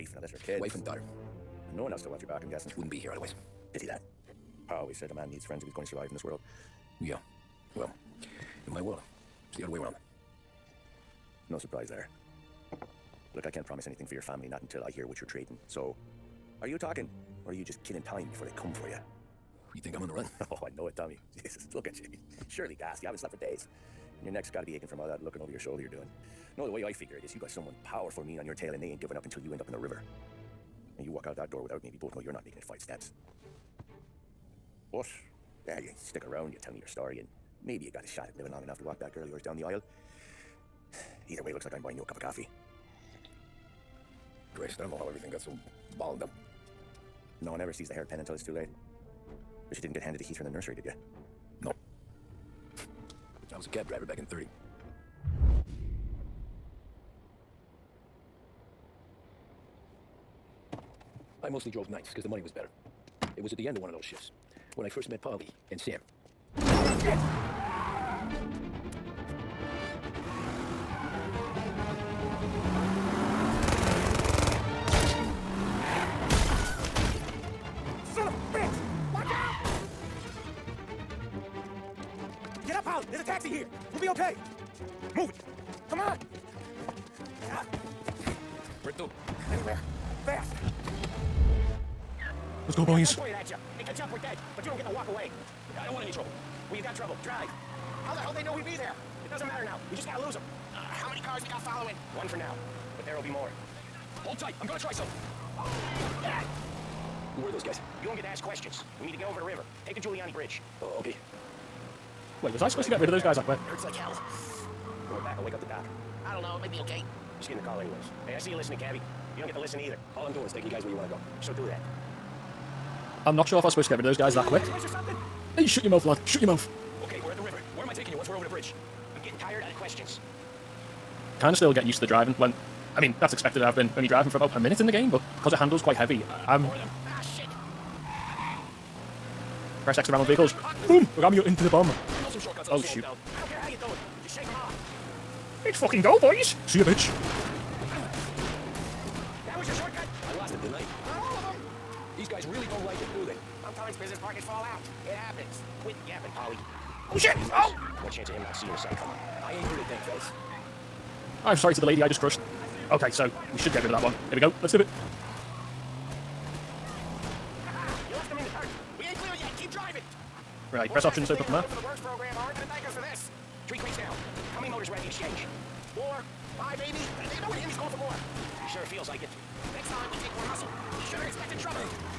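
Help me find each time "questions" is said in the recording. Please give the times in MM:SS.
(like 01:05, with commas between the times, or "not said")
01:48, 02:09.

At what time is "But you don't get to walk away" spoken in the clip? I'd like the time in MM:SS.
01:34.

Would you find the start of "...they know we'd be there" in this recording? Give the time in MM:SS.
01:38.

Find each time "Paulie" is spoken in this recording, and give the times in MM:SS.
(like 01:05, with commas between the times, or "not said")
01:05, 02:36.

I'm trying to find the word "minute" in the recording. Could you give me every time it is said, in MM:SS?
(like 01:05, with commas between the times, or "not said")
02:14.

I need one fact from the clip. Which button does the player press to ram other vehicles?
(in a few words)
X.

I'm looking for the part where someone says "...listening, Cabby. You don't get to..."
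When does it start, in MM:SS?
01:58.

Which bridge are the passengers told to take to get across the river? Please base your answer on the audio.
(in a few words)
Giuliani Bridge.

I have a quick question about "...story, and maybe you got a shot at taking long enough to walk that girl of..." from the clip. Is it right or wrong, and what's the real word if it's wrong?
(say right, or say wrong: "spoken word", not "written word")
wrong: "living", not "taking".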